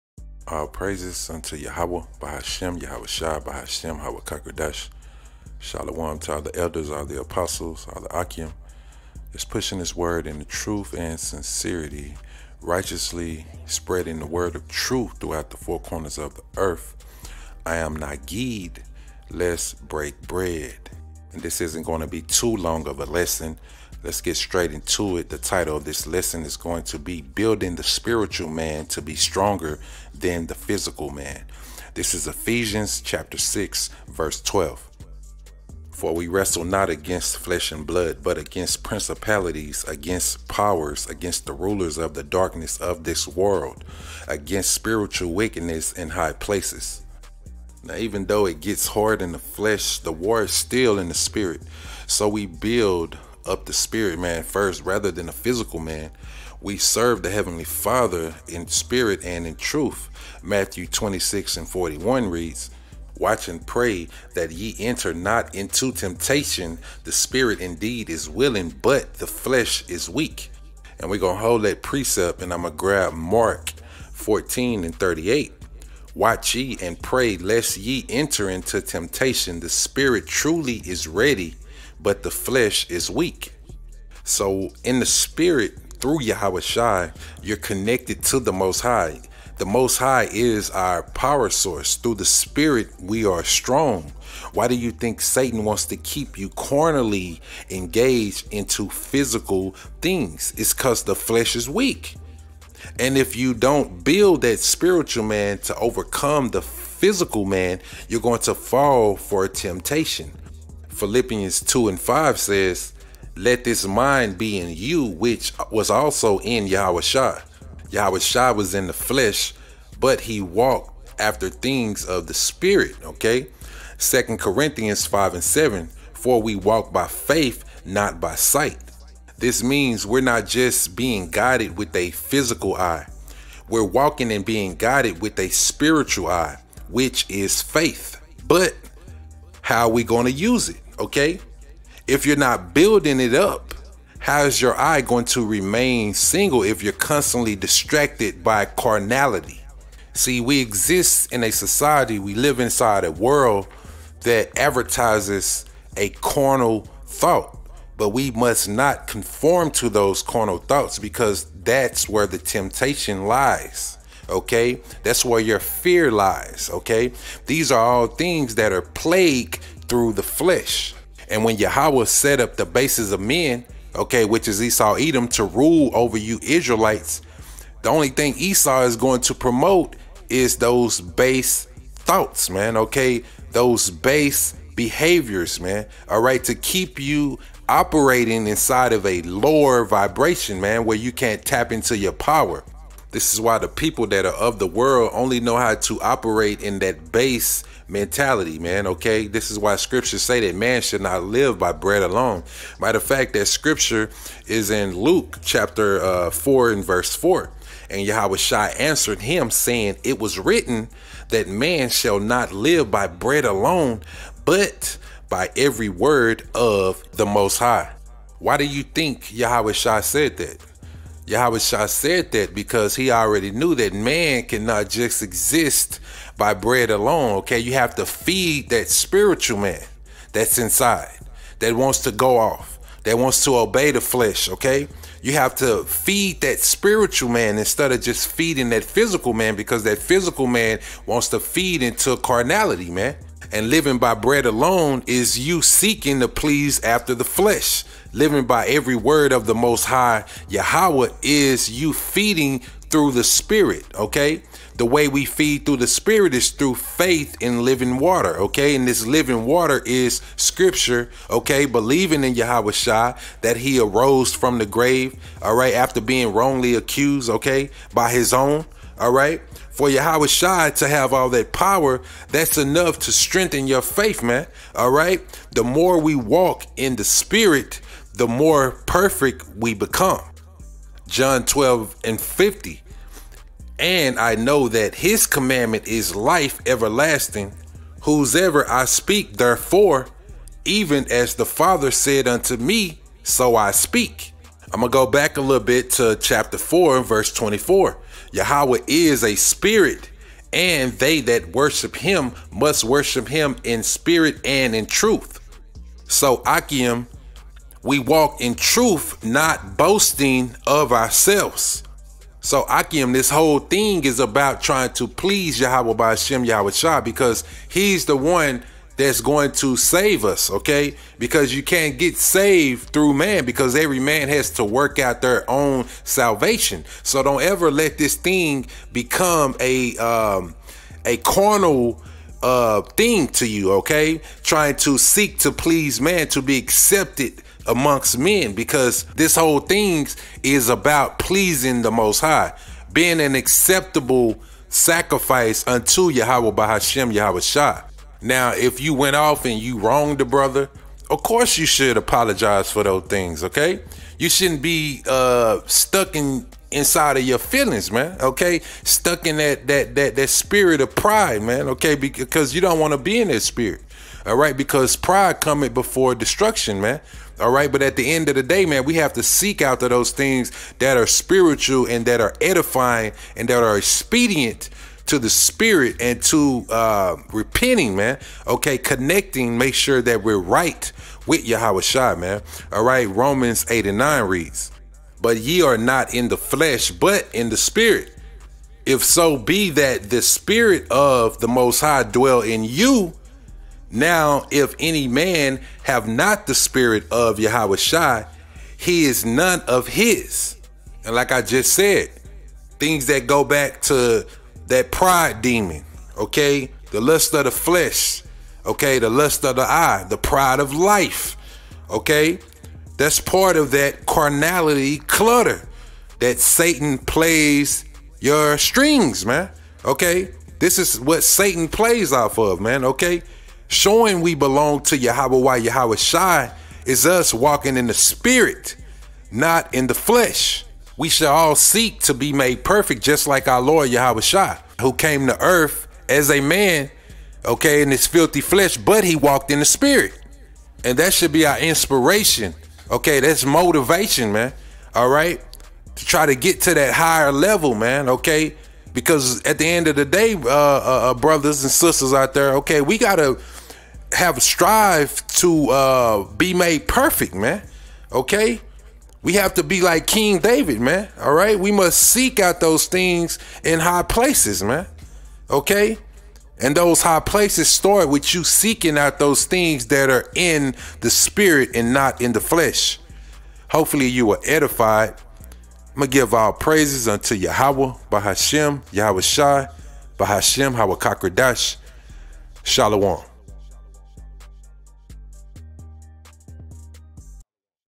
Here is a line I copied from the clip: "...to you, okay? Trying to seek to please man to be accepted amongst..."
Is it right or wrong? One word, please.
right.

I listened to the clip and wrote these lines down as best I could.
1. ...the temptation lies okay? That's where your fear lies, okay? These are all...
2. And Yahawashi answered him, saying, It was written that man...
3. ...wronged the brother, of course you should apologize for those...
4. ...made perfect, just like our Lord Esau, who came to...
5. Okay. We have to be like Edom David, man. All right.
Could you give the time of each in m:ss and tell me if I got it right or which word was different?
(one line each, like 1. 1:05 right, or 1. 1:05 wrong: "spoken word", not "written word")
1. 2:42 right
2. 3:27 right
3. 5:49 right
4. 7:12 wrong: "Yahawashi", not "Esau"
5. 7:38 wrong: "King", not "Edom".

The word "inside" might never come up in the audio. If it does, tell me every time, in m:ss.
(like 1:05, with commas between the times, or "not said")
2:32, 3:08, 3:50, 5:56.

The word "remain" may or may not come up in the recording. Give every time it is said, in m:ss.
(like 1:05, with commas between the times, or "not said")
2:25.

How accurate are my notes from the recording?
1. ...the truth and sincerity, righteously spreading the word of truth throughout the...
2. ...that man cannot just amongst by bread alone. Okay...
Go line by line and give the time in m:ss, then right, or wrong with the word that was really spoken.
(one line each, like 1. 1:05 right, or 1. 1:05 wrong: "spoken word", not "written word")
1. 0:10 right
2. 3:43 wrong: "exist", not "amongst".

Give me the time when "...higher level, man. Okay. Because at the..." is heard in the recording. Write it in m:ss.
7:26.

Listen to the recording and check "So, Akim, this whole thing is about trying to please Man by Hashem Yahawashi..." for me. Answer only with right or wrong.
wrong.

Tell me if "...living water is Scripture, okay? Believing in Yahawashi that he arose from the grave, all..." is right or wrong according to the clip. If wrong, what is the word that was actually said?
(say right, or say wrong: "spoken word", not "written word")
right.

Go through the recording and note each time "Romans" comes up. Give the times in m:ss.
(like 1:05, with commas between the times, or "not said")
6:23.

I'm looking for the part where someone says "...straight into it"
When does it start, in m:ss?
0:24.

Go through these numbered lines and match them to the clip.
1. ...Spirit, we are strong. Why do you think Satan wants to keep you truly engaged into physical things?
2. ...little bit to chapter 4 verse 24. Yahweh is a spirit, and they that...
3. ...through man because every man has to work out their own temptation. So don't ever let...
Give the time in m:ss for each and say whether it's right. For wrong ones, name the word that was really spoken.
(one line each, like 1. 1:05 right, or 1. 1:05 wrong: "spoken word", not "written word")
1. 1:32 wrong: "carnally", not "truly"
2. 4:55 right
3. 5:22 wrong: "salvation", not "temptation".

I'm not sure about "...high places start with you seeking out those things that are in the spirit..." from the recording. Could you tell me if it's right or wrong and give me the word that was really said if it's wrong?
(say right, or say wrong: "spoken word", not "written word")
right.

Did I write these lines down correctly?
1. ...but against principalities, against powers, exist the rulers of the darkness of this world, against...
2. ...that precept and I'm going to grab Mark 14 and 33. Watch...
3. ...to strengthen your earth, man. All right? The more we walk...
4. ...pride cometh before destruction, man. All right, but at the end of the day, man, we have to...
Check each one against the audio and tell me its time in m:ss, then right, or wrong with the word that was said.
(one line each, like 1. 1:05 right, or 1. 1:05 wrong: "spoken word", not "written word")
1. 0:38 wrong: "against", not "exist"
2. 1:11 wrong: "38", not "33"
3. 4:32 wrong: "faith", not "earth"
4. 6:04 right.